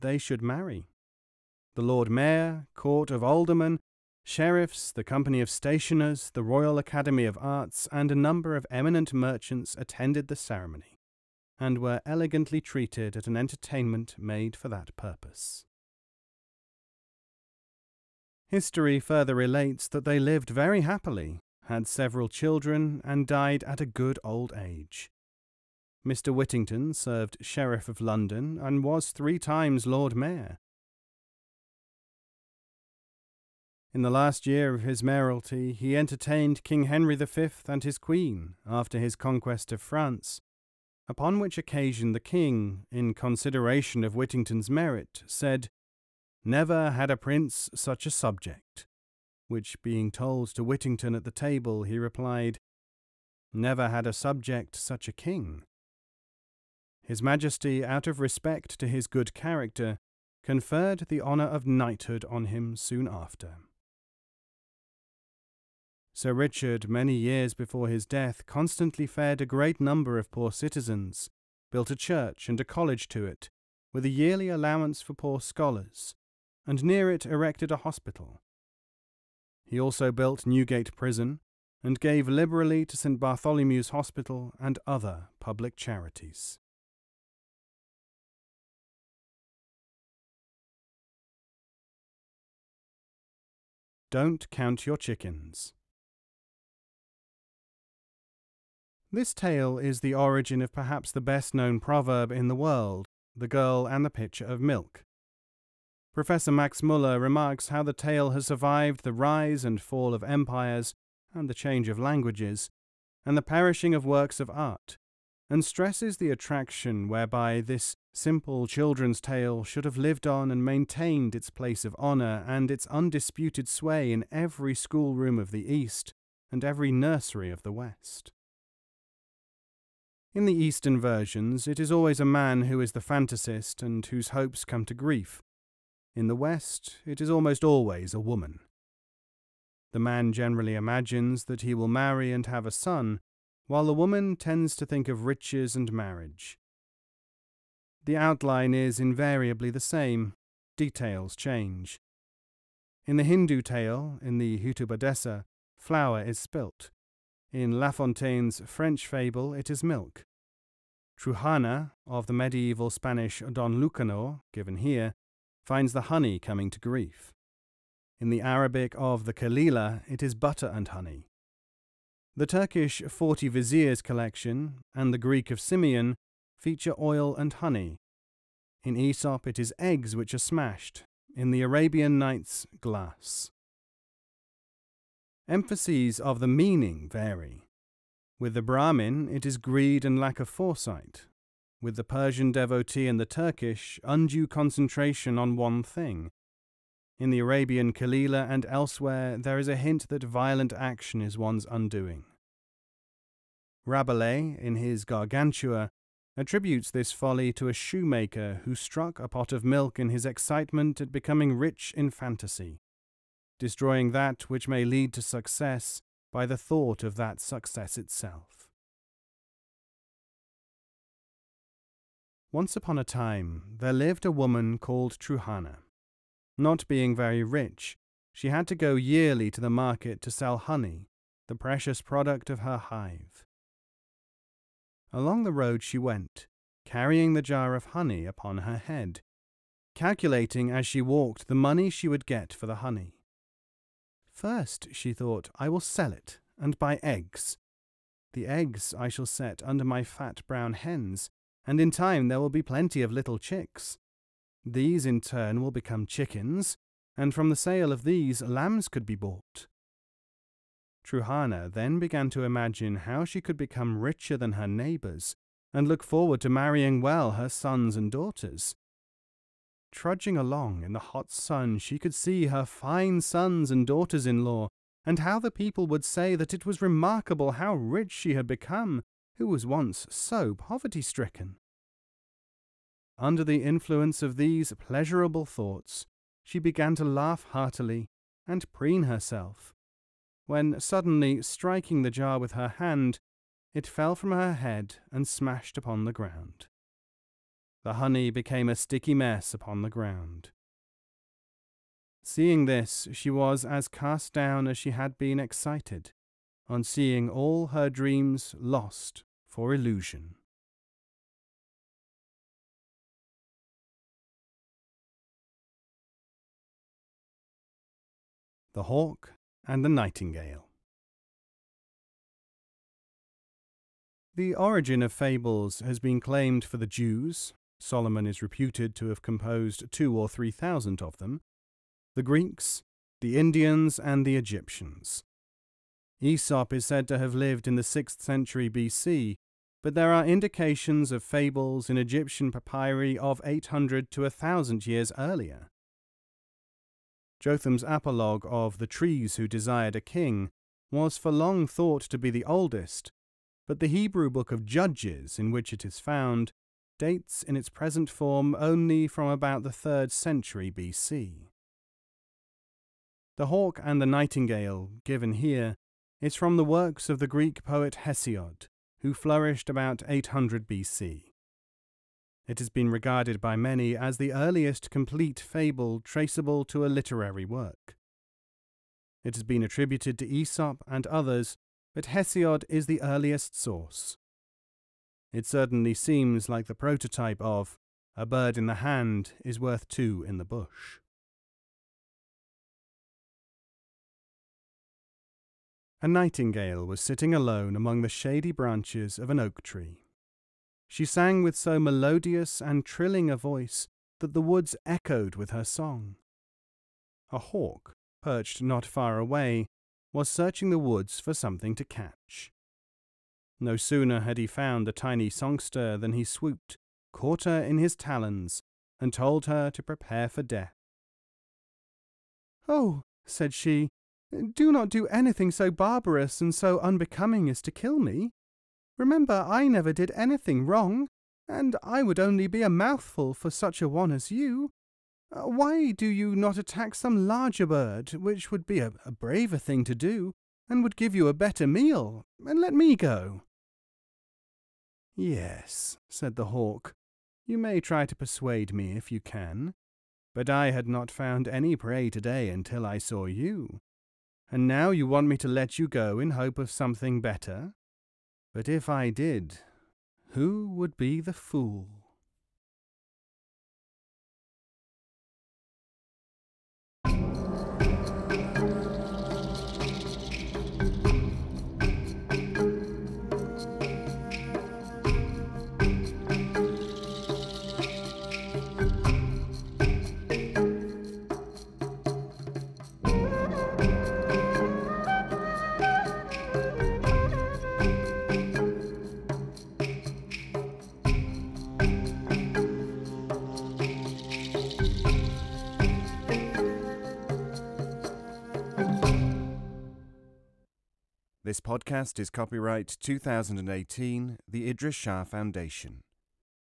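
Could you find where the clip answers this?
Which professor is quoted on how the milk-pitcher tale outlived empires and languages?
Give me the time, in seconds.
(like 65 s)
106 s.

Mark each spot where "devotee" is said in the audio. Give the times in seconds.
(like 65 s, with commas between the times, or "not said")
192 s.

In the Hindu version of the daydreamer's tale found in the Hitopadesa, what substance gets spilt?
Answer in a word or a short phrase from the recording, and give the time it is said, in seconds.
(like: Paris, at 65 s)
Flour, at 155 s.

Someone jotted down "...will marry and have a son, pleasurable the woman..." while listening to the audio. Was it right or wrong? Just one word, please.
wrong.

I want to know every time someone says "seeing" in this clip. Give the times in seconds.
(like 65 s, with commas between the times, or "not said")
302 s, 306 s.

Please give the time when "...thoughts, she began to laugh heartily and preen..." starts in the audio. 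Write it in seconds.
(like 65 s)
285 s.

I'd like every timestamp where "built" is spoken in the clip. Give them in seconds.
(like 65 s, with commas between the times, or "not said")
71 s, 80 s.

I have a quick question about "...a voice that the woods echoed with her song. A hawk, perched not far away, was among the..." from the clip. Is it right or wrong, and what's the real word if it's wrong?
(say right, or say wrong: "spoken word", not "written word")
wrong: "searching", not "among".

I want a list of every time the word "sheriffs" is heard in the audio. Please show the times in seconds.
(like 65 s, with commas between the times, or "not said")
4 s, 27 s.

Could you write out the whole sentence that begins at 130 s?
In the Eastern versions, it is always a man who is the fantasist and whose hopes come to grief.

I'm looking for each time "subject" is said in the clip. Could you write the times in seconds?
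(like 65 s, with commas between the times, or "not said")
48 s, 54 s.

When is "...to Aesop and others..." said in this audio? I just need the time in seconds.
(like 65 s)
380 s.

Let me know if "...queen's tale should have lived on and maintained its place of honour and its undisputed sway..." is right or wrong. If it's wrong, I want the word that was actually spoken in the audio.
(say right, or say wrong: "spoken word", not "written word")
wrong: "children", not "queen".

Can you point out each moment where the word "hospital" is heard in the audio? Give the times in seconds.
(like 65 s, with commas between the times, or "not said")
77 s, 83 s.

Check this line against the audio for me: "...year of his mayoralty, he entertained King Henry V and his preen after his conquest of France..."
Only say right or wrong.
wrong.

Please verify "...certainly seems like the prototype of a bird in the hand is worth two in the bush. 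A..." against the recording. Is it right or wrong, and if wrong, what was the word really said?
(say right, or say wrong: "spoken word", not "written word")
right.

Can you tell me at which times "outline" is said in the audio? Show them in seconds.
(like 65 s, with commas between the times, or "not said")
148 s.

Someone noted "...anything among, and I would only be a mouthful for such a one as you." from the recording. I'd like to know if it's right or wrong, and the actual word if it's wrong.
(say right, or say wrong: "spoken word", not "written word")
wrong: "wrong", not "among".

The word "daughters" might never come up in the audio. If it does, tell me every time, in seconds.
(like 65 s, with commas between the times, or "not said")
268 s, 273 s.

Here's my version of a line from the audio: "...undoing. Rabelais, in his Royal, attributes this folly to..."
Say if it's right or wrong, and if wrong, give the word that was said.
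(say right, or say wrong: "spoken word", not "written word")
wrong: "Gargantua", not "Royal".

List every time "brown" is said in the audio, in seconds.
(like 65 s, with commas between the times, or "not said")
250 s.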